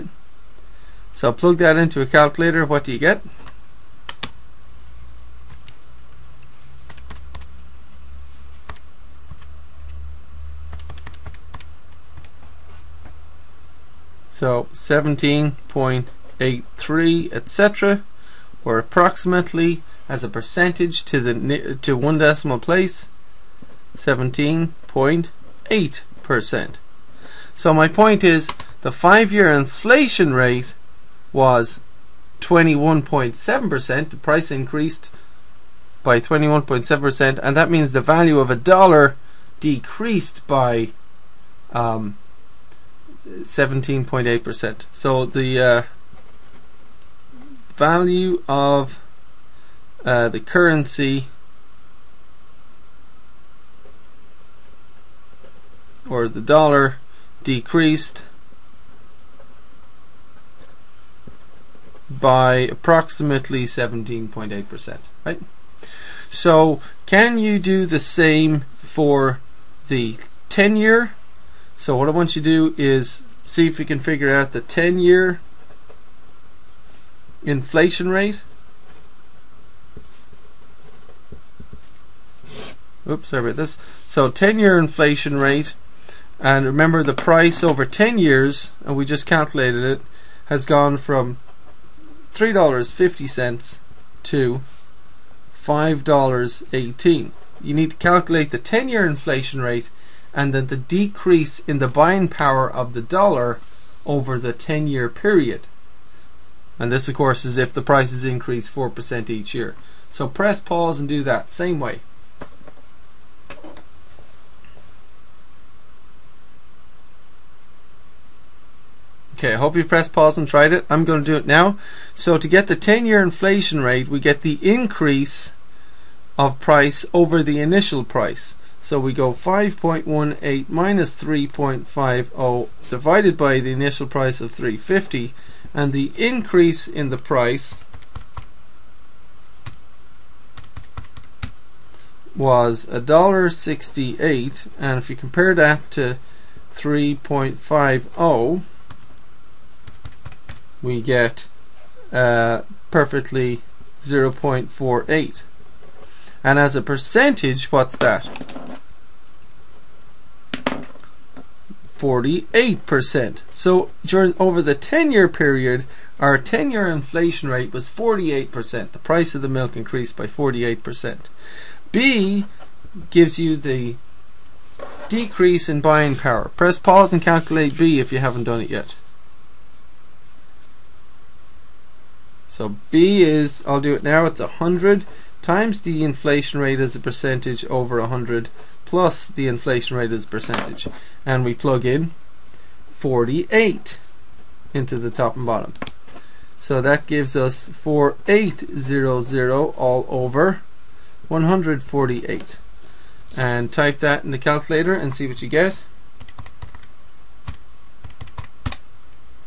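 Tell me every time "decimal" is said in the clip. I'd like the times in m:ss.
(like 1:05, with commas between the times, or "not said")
0:22.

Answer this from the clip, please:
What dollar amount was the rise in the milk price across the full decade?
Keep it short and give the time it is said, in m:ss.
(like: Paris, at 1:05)
$1.68, at 2:22.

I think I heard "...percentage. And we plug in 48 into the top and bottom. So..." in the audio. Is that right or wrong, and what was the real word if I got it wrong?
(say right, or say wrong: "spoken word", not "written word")
right.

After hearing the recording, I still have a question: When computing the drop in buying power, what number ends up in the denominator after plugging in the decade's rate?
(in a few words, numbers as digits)
148.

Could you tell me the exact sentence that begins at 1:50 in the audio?
So press pause and do that same way.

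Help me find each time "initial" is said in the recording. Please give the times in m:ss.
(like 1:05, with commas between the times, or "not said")
2:07, 2:13.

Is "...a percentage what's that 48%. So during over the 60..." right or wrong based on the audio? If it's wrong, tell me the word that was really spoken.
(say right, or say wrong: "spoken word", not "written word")
wrong: "10", not "60".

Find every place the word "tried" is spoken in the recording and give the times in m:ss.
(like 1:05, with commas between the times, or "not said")
2:00.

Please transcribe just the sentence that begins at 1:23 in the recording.
So 10-year inflation rate, and remember the price over 10 years, and we just calculated it, has gone from $3.50 to $5.18.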